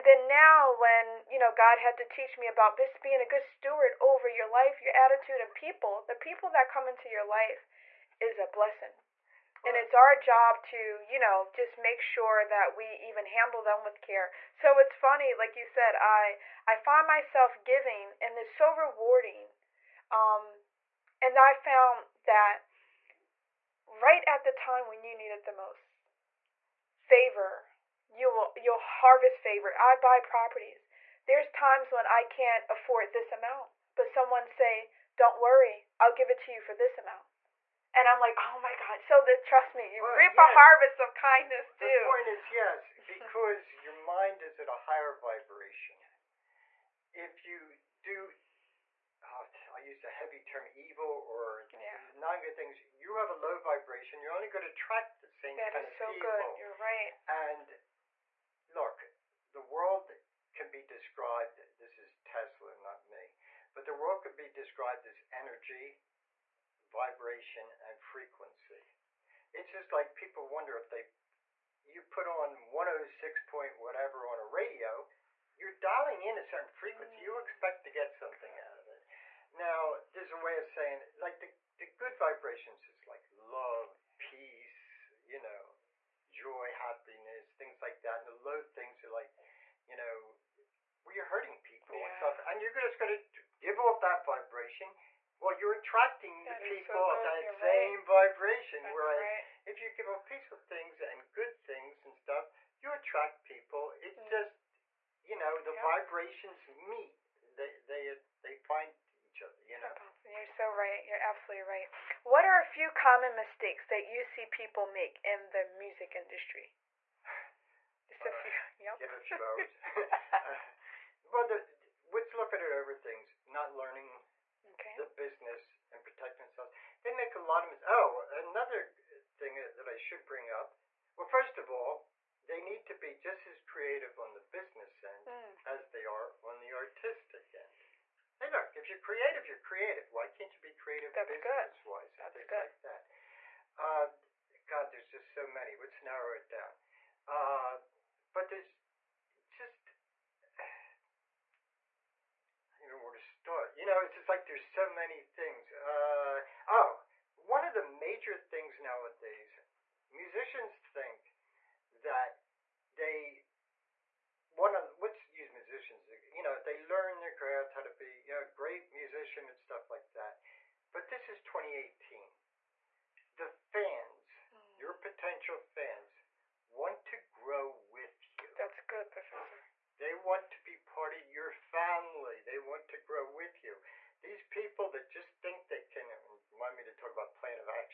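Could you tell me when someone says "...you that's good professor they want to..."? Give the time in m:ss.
2:58.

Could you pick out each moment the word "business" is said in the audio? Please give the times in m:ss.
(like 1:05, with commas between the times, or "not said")
2:05, 2:14, 2:21.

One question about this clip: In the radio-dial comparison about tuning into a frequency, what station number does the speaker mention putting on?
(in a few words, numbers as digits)
106.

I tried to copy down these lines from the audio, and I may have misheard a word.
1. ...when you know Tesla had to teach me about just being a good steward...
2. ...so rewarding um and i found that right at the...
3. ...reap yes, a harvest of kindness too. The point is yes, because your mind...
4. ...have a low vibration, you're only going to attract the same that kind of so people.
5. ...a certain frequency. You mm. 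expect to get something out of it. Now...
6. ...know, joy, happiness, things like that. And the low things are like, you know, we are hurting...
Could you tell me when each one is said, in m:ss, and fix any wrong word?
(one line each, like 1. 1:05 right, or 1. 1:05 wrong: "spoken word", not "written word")
1. 0:00 wrong: "God", not "Tesla"
2. 0:18 right
3. 0:40 right
4. 0:53 right
5. 1:16 right
6. 1:25 right.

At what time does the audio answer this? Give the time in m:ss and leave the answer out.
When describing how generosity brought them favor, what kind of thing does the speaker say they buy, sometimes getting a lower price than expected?
0:30.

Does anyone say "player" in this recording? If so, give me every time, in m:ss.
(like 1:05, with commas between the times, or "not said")
not said.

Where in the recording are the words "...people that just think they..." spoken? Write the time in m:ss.
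3:04.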